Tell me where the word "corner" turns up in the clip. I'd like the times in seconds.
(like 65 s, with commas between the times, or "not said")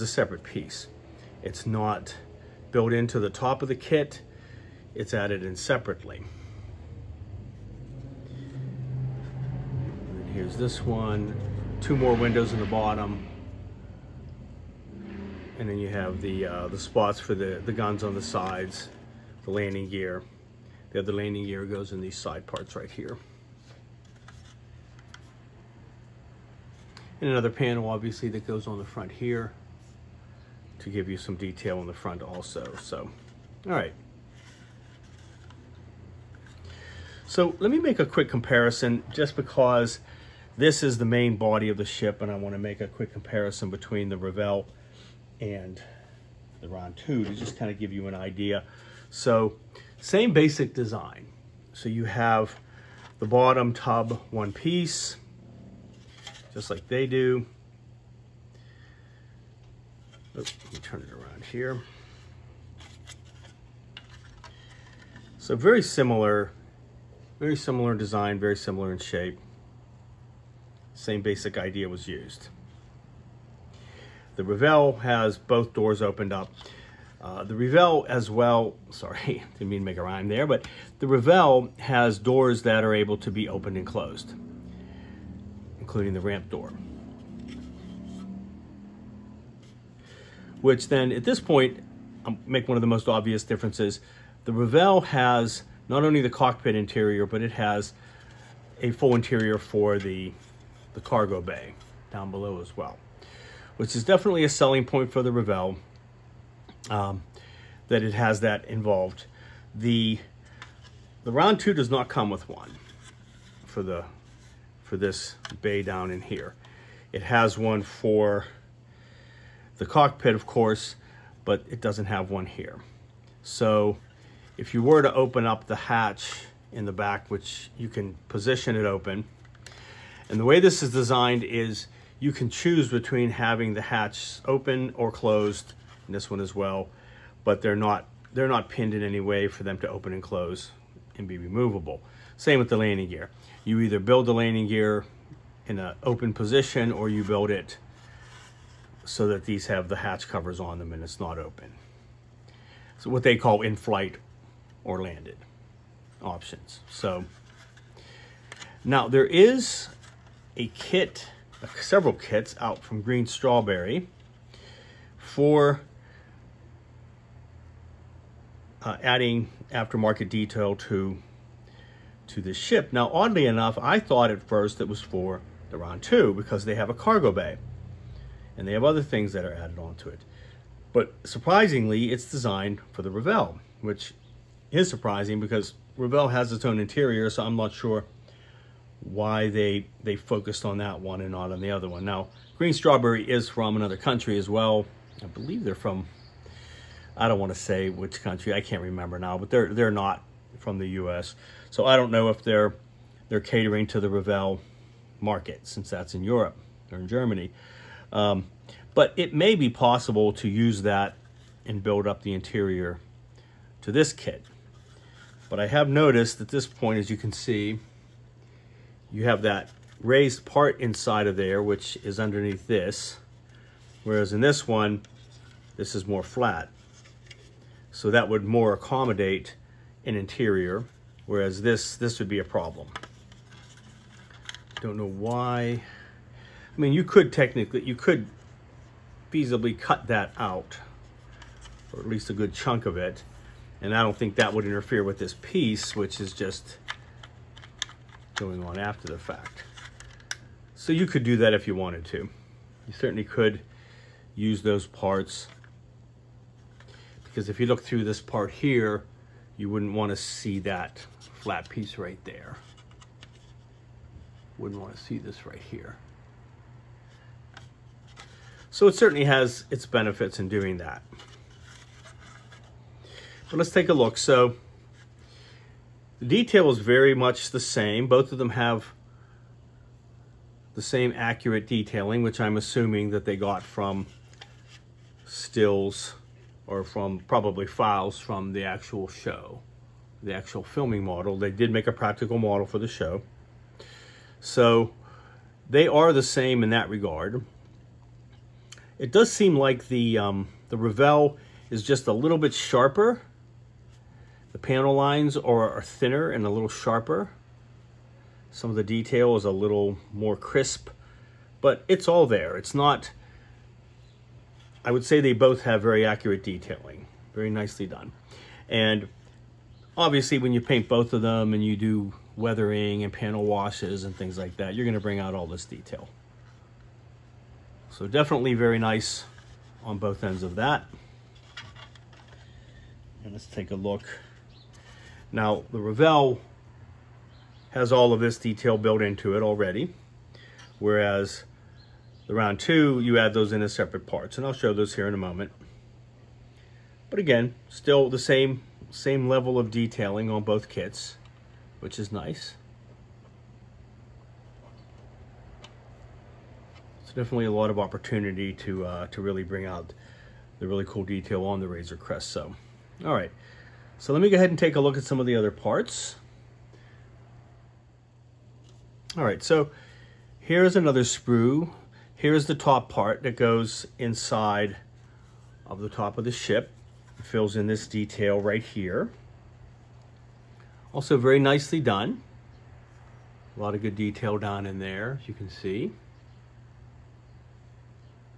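not said.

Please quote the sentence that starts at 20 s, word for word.
The other landing gear goes in these side parts right here.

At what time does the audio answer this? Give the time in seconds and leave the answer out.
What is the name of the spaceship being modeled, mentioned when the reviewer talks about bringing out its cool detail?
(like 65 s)
361 s.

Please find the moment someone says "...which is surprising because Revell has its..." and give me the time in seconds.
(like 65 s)
183 s.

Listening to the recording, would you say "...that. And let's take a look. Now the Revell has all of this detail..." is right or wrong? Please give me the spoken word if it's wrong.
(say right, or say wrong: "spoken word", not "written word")
right.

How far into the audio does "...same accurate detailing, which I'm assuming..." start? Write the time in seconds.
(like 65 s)
280 s.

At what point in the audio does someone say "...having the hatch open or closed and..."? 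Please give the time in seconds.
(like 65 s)
133 s.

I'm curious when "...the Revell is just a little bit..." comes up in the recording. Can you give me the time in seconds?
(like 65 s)
300 s.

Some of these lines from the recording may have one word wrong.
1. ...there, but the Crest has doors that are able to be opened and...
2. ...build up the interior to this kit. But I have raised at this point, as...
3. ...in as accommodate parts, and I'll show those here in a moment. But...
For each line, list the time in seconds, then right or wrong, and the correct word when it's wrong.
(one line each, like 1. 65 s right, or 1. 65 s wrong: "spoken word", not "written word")
1. 80 s wrong: "Revell", not "Crest"
2. 211 s wrong: "noticed", not "raised"
3. 343 s wrong: "separate", not "accommodate".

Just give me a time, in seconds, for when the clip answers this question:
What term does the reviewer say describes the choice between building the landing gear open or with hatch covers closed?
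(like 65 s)
153 s.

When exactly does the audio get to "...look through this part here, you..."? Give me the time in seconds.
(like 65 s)
257 s.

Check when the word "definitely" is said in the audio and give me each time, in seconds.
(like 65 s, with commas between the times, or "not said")
104 s, 328 s, 357 s.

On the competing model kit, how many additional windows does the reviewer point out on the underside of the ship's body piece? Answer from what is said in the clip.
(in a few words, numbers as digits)
2.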